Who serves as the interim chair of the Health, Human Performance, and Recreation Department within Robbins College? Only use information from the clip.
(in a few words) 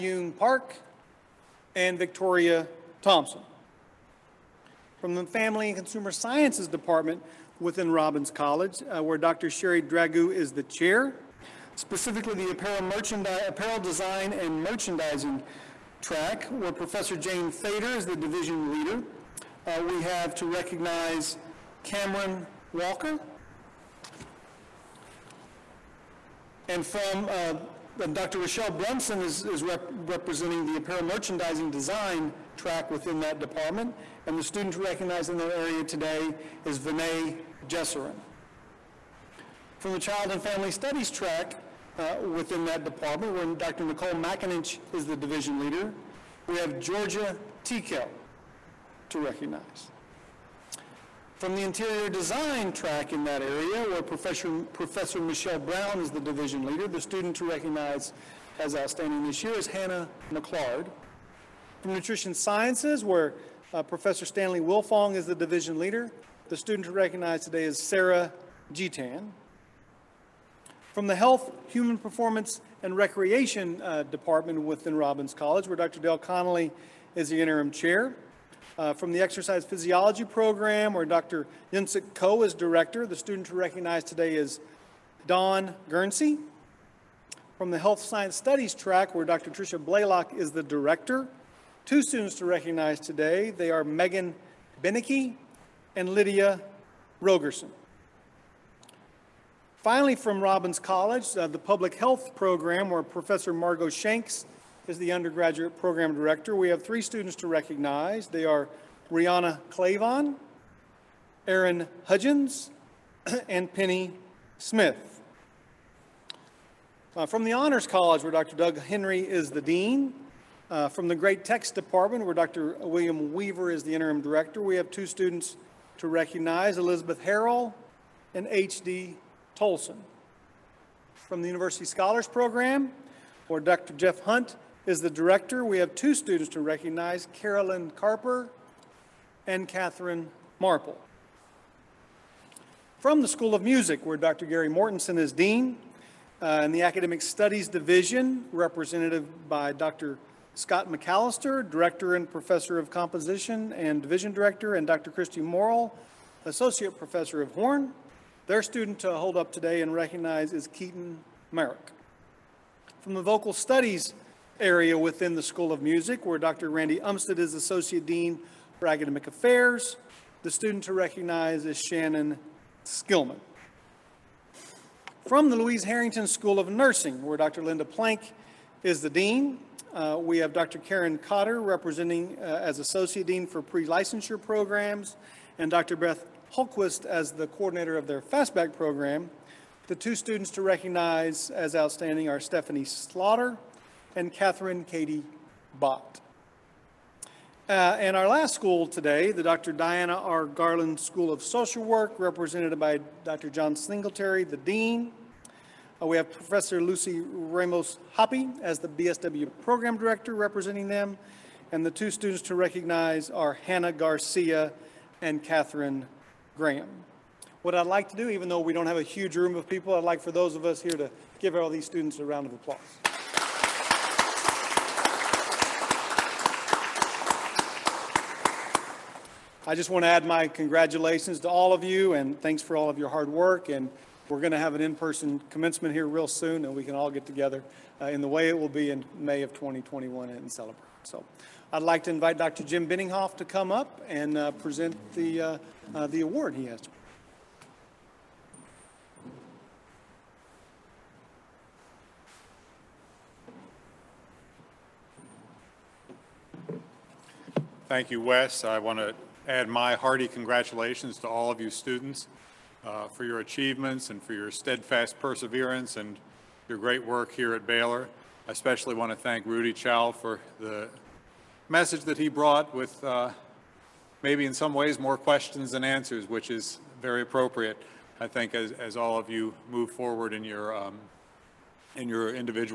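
Dr. Dale Connolly.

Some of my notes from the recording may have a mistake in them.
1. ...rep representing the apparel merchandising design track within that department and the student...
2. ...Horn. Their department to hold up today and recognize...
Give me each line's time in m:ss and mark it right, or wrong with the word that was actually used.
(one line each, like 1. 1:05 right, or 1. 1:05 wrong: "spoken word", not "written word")
1. 0:29 right
2. 2:37 wrong: "student", not "department".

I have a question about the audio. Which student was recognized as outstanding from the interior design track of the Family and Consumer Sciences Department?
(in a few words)
Hannah McClard.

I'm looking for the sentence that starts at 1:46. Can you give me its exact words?
We have three students to recognize.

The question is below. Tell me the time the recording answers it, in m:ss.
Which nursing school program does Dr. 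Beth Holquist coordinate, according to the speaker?
3:08.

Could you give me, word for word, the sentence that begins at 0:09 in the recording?
Sherry Dragoo is the chair, specifically the apparel, merchandise, apparel design and merchandising track, where Professor Jane Fader is the division leader.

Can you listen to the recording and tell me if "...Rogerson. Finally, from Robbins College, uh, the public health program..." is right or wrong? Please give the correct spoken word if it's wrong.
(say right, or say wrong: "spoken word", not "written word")
right.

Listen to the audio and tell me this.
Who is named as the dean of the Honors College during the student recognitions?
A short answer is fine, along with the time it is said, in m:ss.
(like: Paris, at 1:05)
Dr. Doug Henry, at 1:58.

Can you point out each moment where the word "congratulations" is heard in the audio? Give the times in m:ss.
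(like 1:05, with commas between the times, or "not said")
3:50, 4:20.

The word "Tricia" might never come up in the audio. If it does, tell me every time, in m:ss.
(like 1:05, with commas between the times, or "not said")
1:29.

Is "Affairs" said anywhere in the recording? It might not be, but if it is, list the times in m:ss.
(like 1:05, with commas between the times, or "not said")
2:49.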